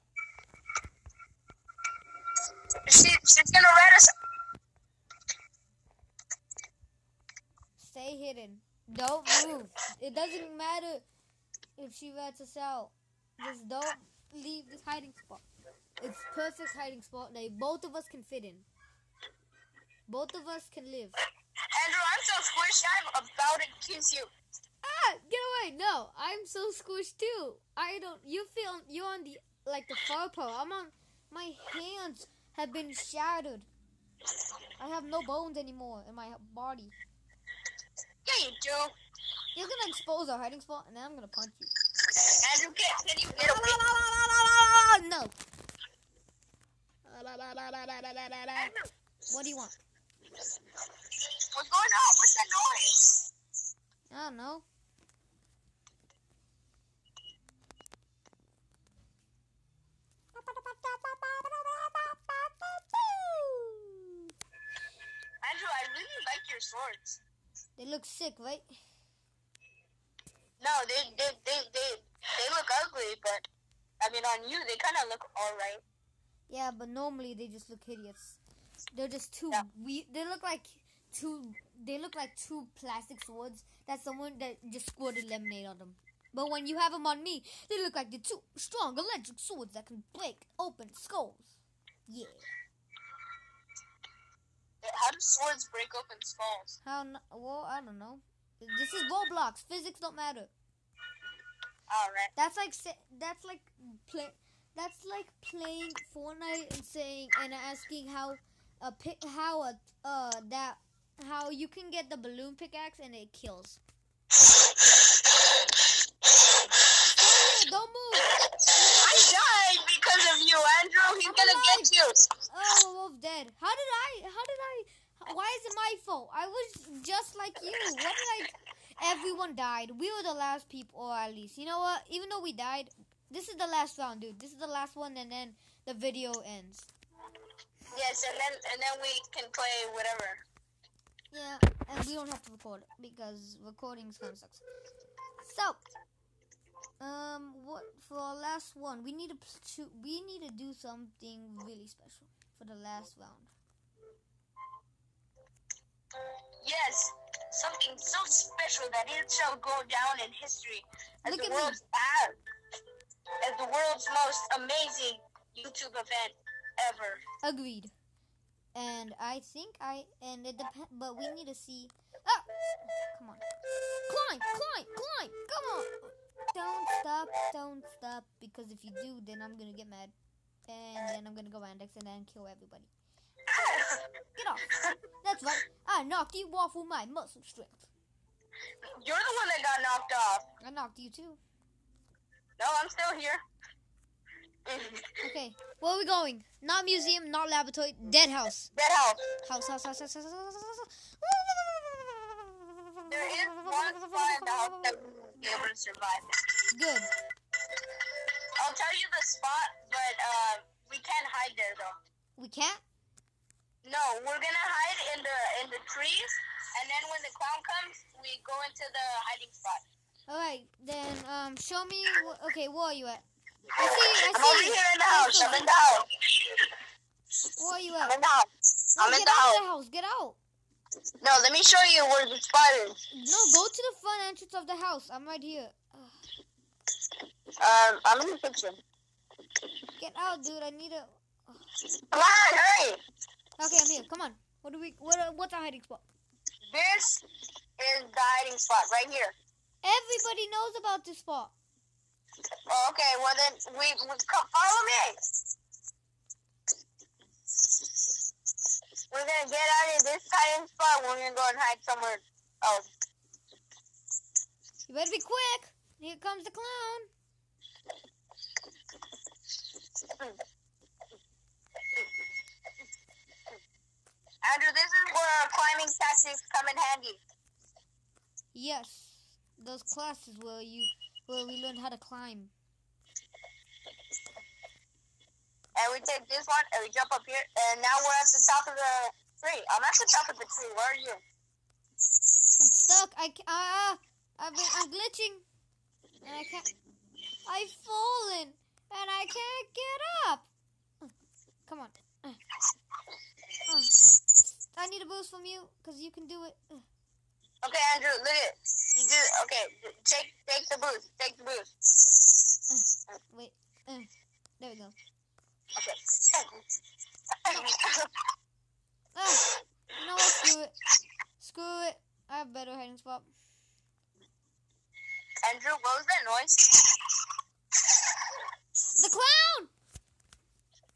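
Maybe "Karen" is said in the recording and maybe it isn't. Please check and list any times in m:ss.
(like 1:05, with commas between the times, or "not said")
not said.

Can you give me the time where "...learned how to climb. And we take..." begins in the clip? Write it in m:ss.
4:41.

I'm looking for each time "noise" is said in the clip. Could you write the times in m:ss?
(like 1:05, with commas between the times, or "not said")
0:52, 5:26.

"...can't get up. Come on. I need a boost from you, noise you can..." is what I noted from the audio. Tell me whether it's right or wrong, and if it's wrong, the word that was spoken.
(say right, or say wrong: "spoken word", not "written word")
wrong: "cause", not "noise".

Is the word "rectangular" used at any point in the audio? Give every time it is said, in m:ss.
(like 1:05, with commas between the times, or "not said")
not said.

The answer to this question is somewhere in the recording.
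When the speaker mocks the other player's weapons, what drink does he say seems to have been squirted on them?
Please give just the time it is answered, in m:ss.
1:25.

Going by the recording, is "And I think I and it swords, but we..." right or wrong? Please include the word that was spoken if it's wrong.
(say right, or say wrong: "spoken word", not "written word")
wrong: "depends", not "swords".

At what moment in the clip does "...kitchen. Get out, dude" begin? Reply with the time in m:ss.
3:58.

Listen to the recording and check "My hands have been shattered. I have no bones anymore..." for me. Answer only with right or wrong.
right.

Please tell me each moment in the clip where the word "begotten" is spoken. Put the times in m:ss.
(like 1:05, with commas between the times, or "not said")
not said.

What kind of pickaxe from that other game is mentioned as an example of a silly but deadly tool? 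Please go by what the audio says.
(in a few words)
Balloon pickaxe.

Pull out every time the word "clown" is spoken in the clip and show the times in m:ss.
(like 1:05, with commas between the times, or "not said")
3:37, 4:26, 5:29.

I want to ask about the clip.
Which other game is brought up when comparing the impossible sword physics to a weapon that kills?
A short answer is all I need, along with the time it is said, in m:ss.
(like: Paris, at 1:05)
Fortnite, at 1:46.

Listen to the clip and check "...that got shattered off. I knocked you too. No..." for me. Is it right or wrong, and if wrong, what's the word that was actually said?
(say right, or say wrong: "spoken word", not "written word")
wrong: "knocked", not "shattered".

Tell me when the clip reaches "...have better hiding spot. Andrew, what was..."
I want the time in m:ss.
5:22.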